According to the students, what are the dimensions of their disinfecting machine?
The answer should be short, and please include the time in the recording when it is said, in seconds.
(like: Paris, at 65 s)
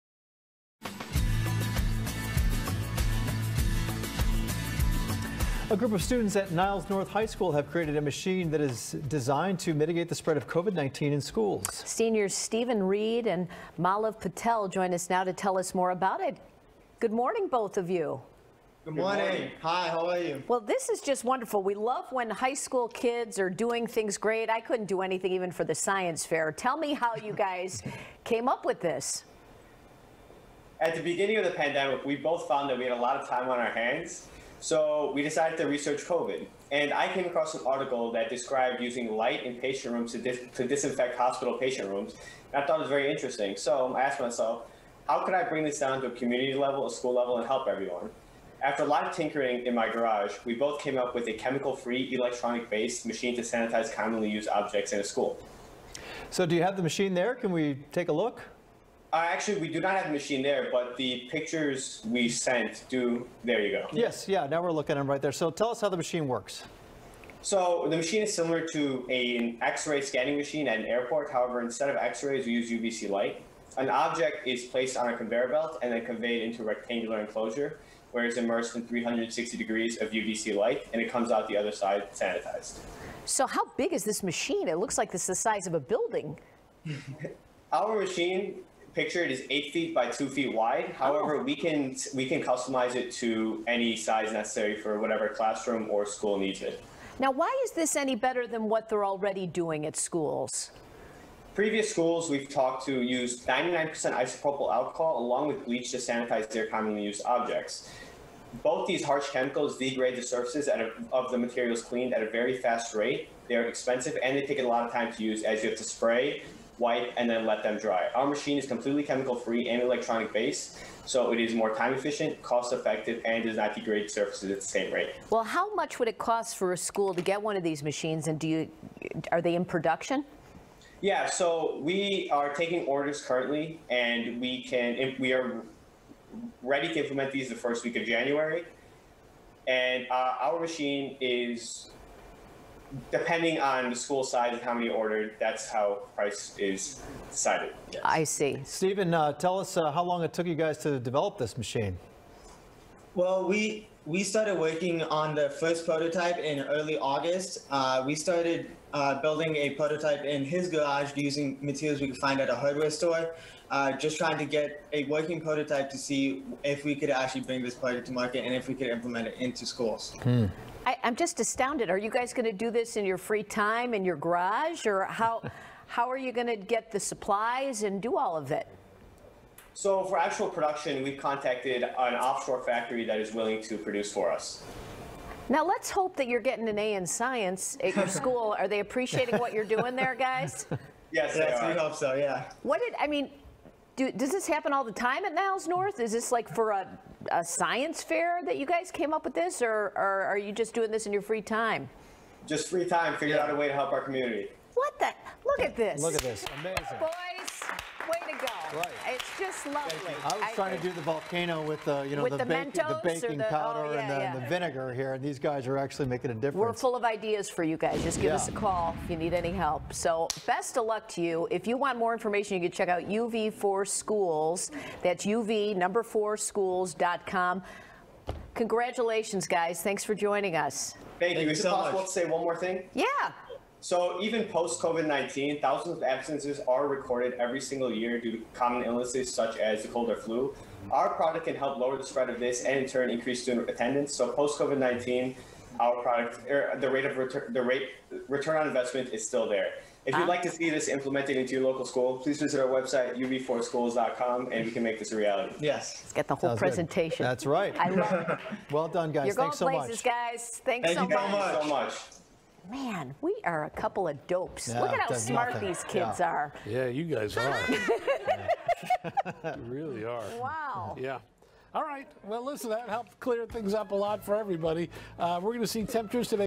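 8 feet by 2 feet, at 89 s.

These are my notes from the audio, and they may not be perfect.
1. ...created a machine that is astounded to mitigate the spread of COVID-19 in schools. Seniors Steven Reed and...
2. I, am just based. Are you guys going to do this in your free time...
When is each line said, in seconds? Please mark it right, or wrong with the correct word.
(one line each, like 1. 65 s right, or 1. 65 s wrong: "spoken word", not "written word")
1. 7 s wrong: "designed", not "astounded"
2. 170 s wrong: "astounded", not "based".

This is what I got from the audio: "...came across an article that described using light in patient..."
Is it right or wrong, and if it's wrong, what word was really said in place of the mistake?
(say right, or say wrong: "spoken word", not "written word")
right.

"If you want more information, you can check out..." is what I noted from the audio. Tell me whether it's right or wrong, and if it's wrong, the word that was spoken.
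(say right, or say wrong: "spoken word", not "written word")
right.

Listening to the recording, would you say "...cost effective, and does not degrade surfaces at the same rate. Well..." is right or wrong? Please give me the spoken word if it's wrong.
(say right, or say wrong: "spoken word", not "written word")
right.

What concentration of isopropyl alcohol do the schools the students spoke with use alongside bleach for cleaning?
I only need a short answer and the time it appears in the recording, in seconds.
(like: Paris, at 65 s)
99%, at 103 s.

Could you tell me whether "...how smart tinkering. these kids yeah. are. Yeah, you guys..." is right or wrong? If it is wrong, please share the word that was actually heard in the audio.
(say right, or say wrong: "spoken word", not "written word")
wrong: "nothing", not "tinkering".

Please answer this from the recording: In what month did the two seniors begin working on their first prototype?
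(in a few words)
August.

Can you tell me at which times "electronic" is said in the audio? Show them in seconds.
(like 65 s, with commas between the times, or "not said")
52 s, 119 s.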